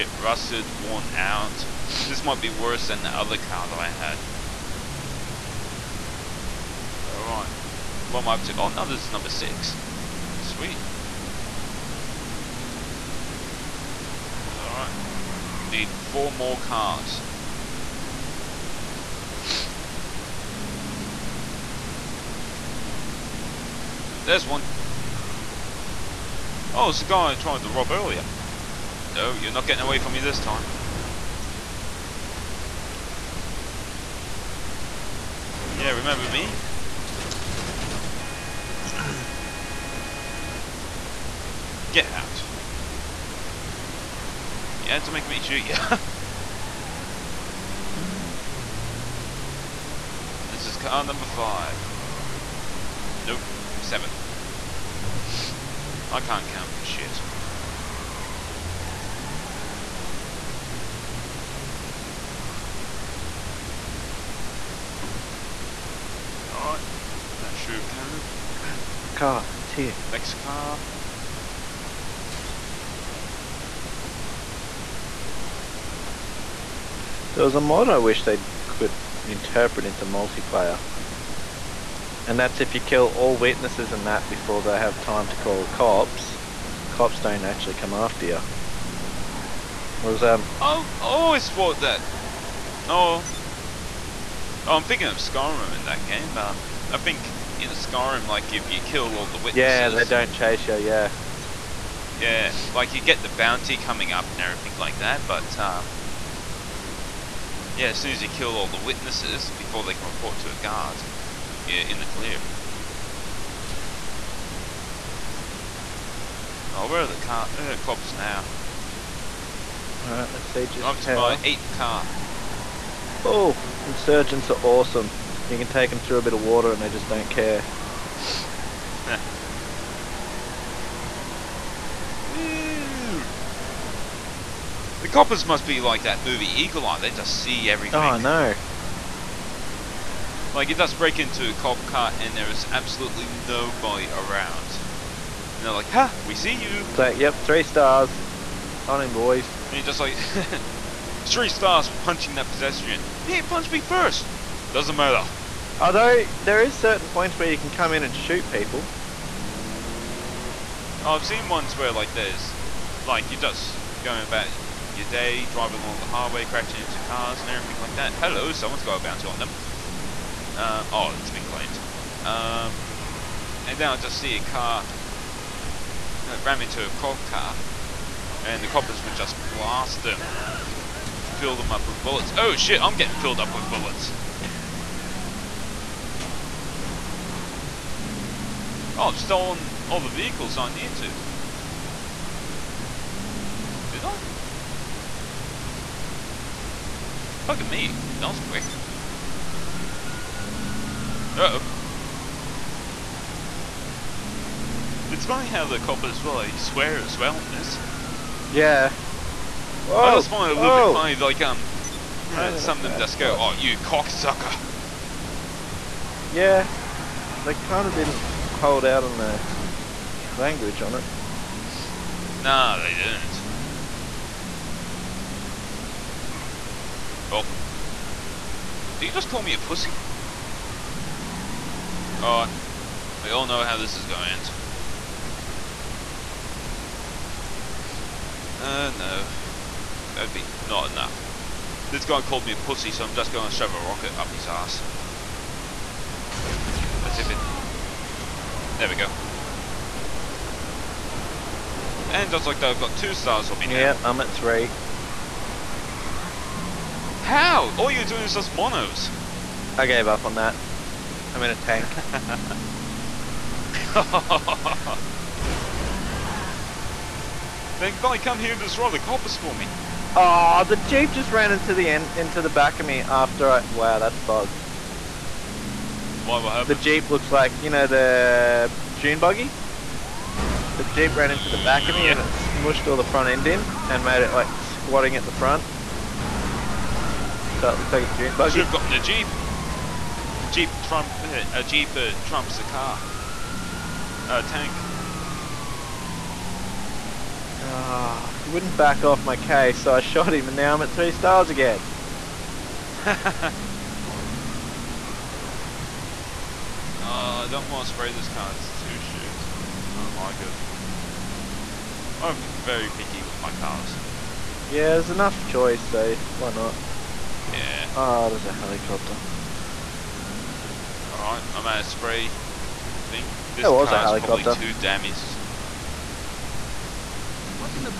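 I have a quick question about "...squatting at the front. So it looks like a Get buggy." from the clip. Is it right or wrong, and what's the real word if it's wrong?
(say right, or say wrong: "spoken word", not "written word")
wrong: "June", not "Get".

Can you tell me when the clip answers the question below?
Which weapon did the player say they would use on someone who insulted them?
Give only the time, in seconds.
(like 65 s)
243 s.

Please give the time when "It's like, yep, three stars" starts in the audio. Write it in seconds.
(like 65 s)
146 s.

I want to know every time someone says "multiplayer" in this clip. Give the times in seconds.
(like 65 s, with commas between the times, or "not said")
80 s.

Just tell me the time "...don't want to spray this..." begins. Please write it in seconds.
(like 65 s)
307 s.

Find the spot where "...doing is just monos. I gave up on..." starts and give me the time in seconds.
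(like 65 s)
258 s.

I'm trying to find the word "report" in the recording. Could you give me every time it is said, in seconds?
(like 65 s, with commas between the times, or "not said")
110 s.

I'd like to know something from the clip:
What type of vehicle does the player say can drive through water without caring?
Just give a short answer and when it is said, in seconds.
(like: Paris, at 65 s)
Insurgents, at 123 s.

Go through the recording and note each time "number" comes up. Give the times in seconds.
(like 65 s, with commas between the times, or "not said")
9 s, 51 s.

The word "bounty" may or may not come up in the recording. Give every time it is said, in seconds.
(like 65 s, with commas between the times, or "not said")
103 s, 168 s.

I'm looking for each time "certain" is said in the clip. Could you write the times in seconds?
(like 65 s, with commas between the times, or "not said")
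156 s.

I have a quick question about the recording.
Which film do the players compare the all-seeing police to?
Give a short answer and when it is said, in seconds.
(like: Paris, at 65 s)
Eagle Eye, at 136 s.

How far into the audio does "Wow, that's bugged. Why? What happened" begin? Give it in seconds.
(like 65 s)
273 s.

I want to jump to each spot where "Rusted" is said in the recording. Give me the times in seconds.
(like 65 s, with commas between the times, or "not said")
0 s.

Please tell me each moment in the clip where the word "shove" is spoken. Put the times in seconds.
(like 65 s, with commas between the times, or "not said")
243 s.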